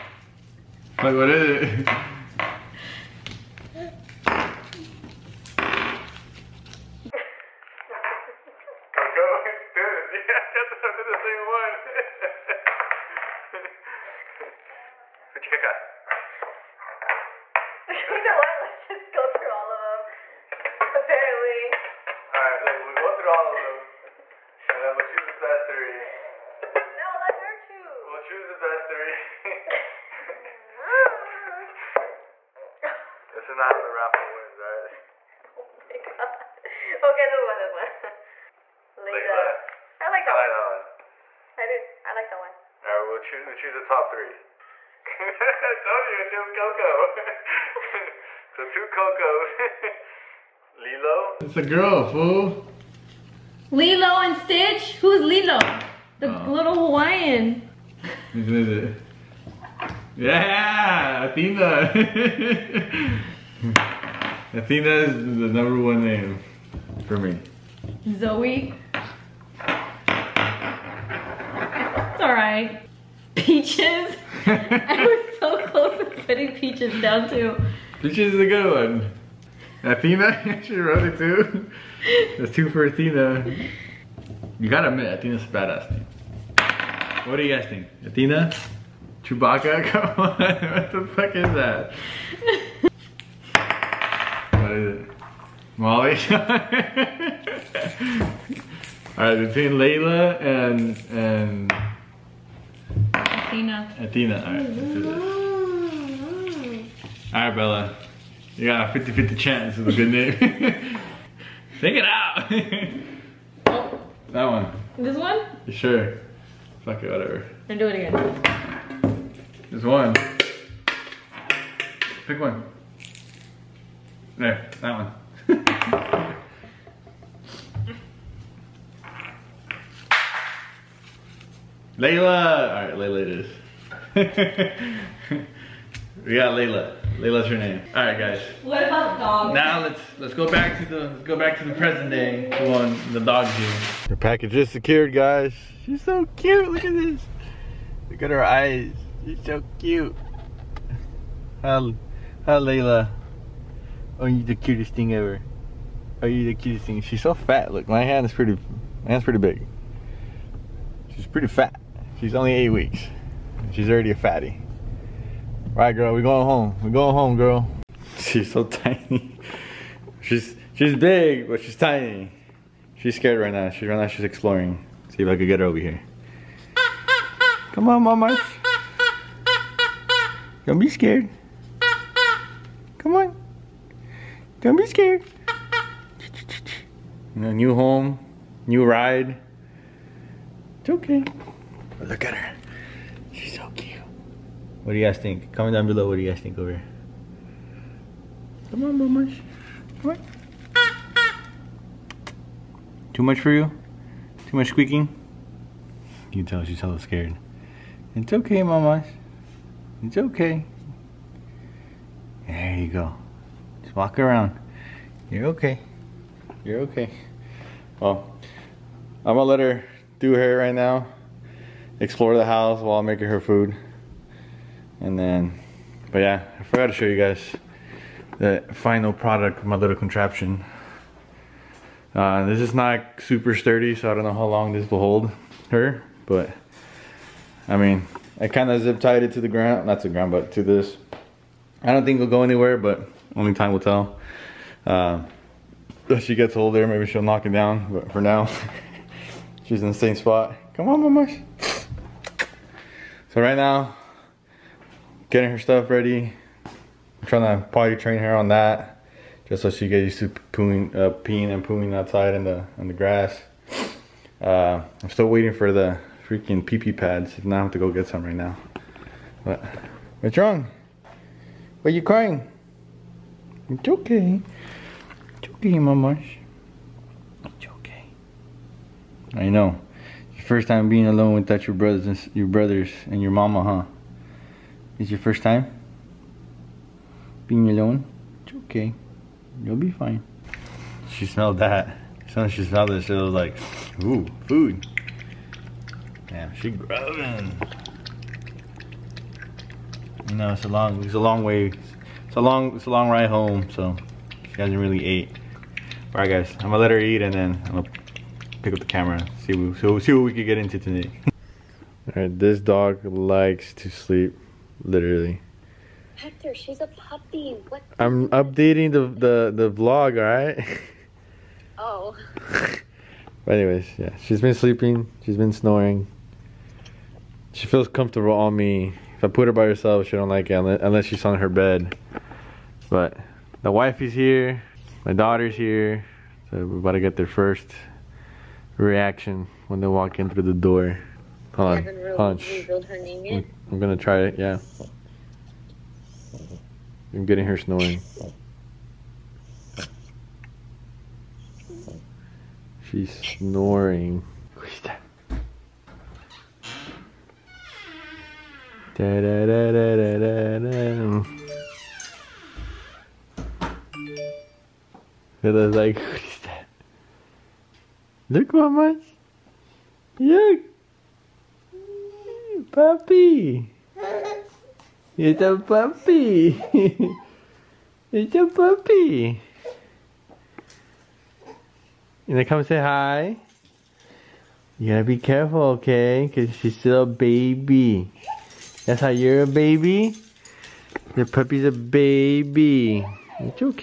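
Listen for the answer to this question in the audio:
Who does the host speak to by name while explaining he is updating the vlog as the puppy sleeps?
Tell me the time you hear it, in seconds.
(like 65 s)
316 s.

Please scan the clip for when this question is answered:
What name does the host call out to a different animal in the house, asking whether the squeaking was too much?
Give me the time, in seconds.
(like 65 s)
198 s.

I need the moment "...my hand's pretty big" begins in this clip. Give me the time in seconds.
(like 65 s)
159 s.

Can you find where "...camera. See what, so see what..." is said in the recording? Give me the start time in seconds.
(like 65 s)
308 s.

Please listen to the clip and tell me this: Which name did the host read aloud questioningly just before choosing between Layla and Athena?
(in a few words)
Molly.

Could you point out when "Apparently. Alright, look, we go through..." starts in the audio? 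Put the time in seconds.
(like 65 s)
20 s.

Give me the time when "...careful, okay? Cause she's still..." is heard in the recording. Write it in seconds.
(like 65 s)
385 s.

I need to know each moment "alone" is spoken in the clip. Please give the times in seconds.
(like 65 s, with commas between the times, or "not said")
281 s, 287 s.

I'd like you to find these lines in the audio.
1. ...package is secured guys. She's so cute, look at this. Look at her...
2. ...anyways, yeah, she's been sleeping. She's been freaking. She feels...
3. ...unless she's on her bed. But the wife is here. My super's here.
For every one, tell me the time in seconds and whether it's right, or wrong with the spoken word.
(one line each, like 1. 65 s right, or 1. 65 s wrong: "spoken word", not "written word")
1. 144 s right
2. 323 s wrong: "snoring", not "freaking"
3. 330 s wrong: "daughter", not "super".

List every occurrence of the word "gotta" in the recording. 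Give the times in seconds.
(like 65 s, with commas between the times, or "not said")
84 s, 384 s.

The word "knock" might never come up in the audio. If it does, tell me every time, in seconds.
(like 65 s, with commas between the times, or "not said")
247 s.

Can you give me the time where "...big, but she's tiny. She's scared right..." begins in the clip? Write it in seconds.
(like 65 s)
170 s.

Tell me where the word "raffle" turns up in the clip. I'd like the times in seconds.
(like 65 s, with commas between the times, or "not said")
33 s.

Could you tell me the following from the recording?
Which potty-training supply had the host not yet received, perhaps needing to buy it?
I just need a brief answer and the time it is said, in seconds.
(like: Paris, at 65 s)
Pee pee pads, at 266 s.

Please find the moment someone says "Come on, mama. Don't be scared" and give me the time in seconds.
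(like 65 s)
177 s.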